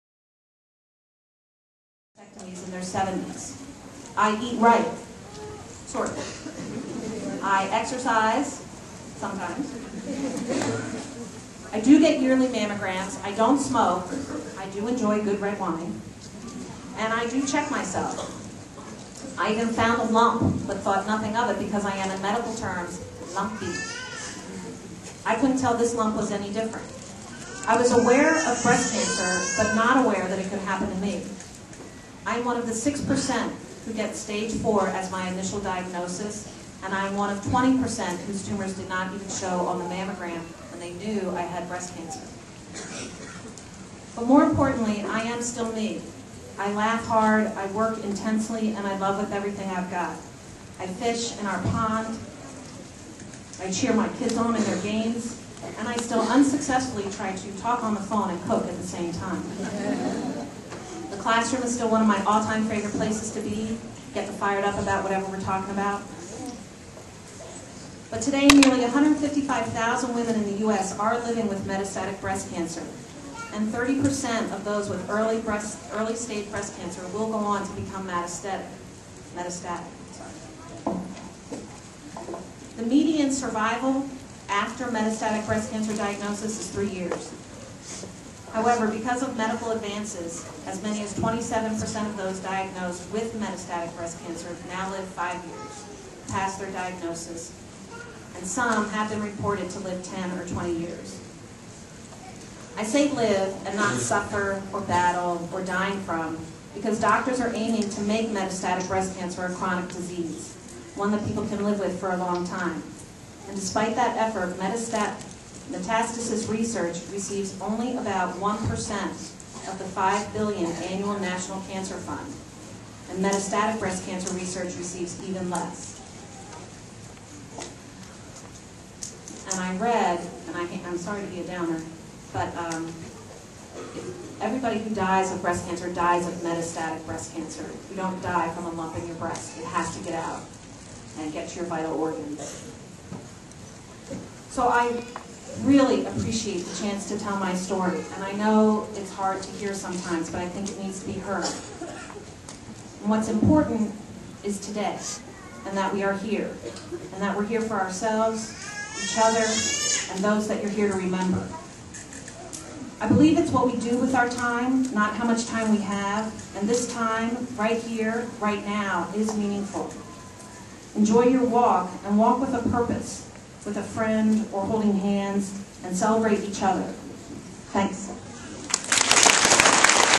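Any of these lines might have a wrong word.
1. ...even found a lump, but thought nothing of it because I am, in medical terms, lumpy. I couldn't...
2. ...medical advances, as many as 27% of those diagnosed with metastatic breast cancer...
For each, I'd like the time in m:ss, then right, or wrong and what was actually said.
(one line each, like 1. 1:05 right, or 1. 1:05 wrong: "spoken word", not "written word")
1. 0:19 right
2. 1:29 right.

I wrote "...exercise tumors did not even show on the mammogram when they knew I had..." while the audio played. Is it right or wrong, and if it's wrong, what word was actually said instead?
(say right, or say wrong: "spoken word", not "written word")
wrong: "whose", not "exercise".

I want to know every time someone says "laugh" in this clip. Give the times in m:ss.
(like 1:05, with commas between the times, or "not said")
0:46.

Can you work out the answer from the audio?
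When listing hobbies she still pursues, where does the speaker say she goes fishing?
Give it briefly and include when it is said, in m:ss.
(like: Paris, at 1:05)
In our pond, at 0:51.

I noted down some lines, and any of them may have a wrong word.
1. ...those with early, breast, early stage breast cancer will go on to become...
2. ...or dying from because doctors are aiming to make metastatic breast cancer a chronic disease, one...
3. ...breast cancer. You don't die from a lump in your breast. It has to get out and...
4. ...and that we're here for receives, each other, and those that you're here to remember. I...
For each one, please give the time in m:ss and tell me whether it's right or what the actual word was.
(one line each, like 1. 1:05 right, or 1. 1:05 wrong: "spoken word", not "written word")
1. 1:14 right
2. 1:45 right
3. 2:17 right
4. 2:37 wrong: "ourselves", not "receives".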